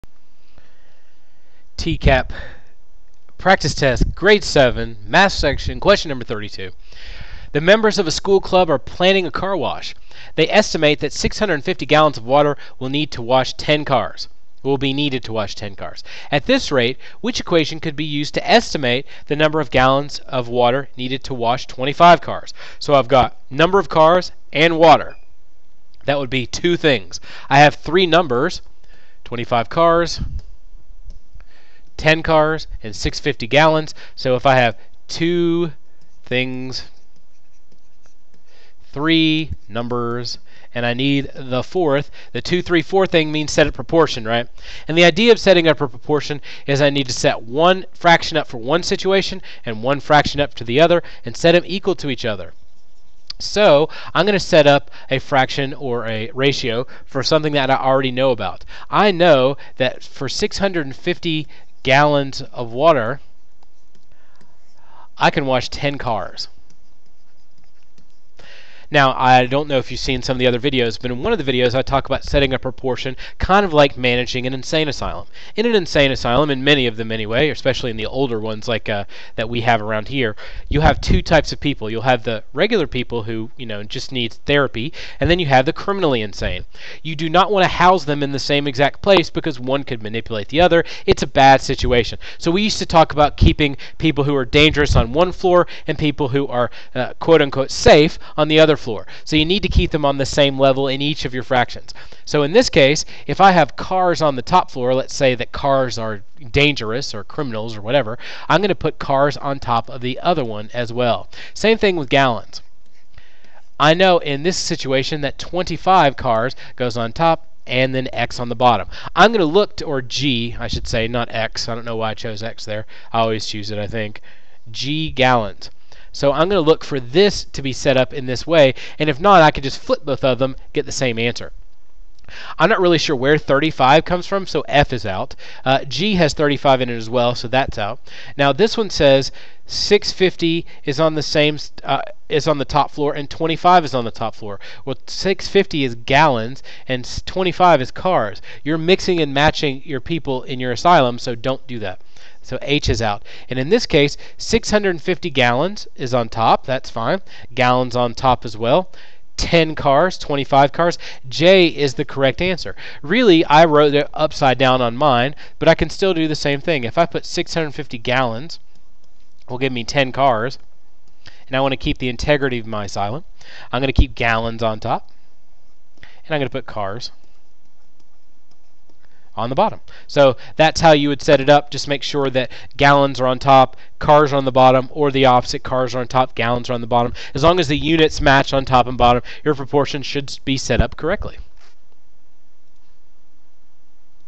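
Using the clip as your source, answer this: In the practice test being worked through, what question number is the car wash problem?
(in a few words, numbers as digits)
32.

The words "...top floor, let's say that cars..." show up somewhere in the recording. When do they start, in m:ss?
1:44.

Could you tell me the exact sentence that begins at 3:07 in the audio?
As long as the units match on top and bottom, your proportions should be set up correctly.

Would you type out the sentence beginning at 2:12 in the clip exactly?
I'm not really sure where 35 comes from, so F is out.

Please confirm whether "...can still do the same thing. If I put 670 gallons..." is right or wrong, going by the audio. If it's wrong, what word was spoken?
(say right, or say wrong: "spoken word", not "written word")
wrong: "650", not "670".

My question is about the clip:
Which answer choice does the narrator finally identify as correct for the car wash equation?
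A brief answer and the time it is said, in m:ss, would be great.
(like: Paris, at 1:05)
J, at 2:41.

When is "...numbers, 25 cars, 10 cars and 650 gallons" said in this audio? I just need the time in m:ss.
0:28.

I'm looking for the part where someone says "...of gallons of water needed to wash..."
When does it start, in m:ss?
0:19.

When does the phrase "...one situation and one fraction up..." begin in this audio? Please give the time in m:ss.
0:48.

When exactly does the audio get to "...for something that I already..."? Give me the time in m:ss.
0:57.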